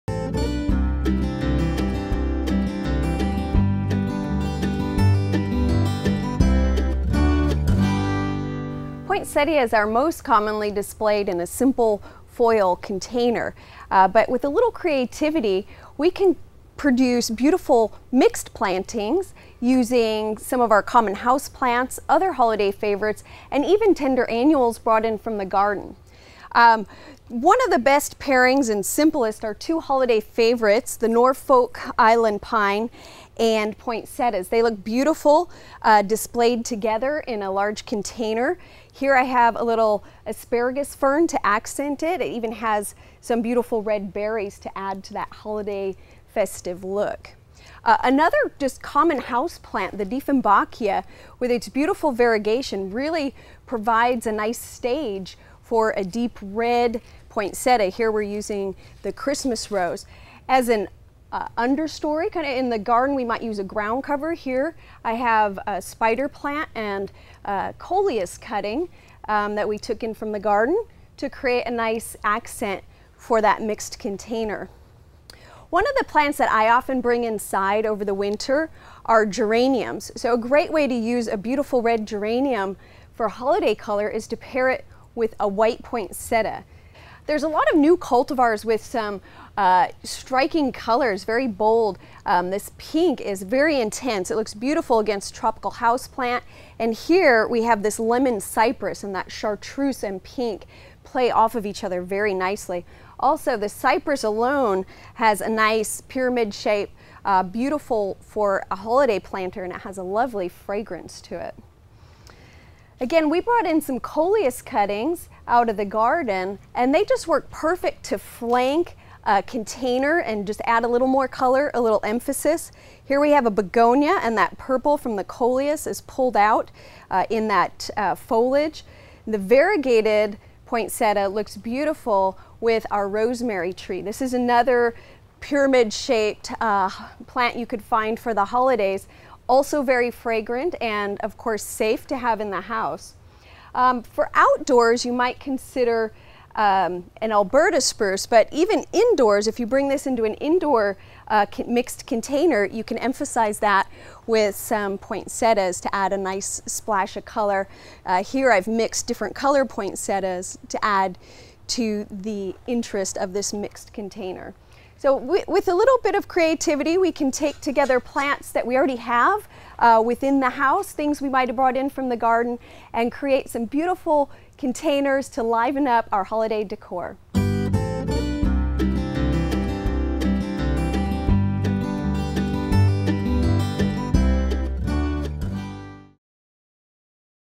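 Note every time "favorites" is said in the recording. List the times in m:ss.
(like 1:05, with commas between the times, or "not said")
0:22, 0:30.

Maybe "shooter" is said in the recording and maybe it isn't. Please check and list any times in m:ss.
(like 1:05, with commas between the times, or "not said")
not said.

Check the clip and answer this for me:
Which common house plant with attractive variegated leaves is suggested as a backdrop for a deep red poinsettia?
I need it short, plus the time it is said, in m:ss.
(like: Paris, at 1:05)
Dieffenbachia, at 0:50.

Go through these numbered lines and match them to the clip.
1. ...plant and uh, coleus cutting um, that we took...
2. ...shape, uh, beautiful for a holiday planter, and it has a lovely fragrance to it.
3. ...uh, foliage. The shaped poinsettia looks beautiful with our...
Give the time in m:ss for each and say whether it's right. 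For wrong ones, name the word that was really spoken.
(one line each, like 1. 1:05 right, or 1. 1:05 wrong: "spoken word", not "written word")
1. 1:06 right
2. 1:46 right
3. 2:07 wrong: "variegated", not "shaped".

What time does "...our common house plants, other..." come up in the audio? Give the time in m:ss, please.
0:20.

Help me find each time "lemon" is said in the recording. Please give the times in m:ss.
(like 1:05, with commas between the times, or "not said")
1:37.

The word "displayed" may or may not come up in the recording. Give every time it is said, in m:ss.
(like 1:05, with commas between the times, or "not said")
0:10, 0:36.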